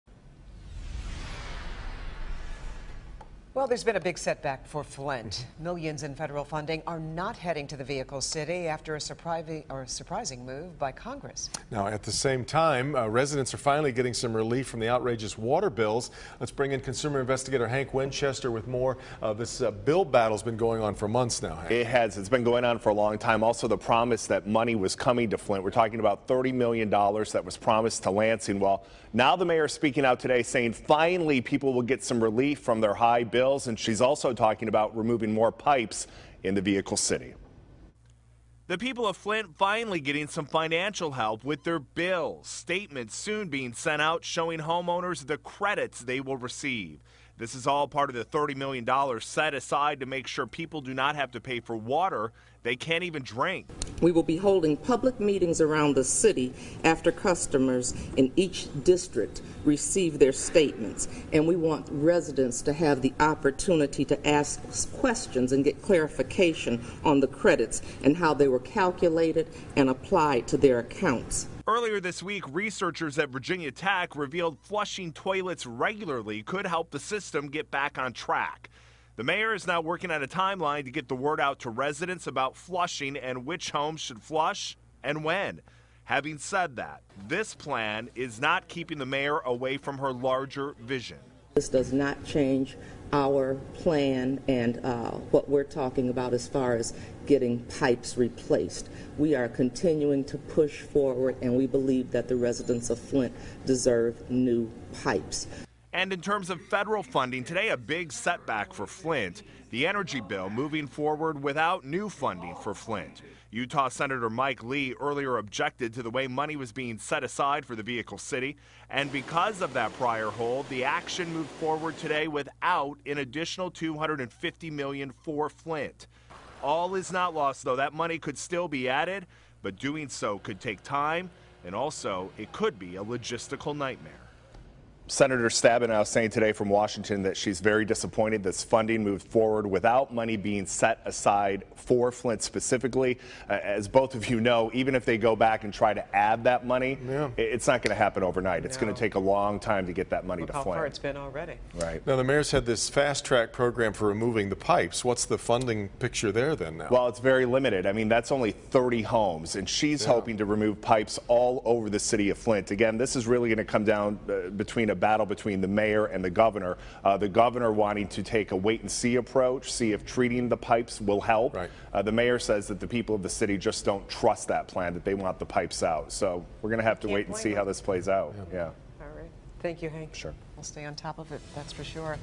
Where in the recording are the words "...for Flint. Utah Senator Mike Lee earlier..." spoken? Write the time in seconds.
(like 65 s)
112 s.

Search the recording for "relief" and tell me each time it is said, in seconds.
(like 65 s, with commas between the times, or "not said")
14 s, 32 s.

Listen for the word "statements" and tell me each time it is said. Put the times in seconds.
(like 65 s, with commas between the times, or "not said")
42 s, 60 s.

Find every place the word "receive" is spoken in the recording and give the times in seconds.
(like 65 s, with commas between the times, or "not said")
46 s, 59 s.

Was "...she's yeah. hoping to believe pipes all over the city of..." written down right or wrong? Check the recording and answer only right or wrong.
wrong.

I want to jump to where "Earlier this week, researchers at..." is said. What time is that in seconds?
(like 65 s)
71 s.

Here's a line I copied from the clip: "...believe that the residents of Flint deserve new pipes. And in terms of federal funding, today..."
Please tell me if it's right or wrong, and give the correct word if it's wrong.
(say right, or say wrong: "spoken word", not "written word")
right.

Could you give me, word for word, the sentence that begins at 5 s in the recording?
Millions in federal funding are not heading to the vehicle city after a surprising, or surprising move by Congress.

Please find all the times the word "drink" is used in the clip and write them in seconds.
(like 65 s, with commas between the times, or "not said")
53 s.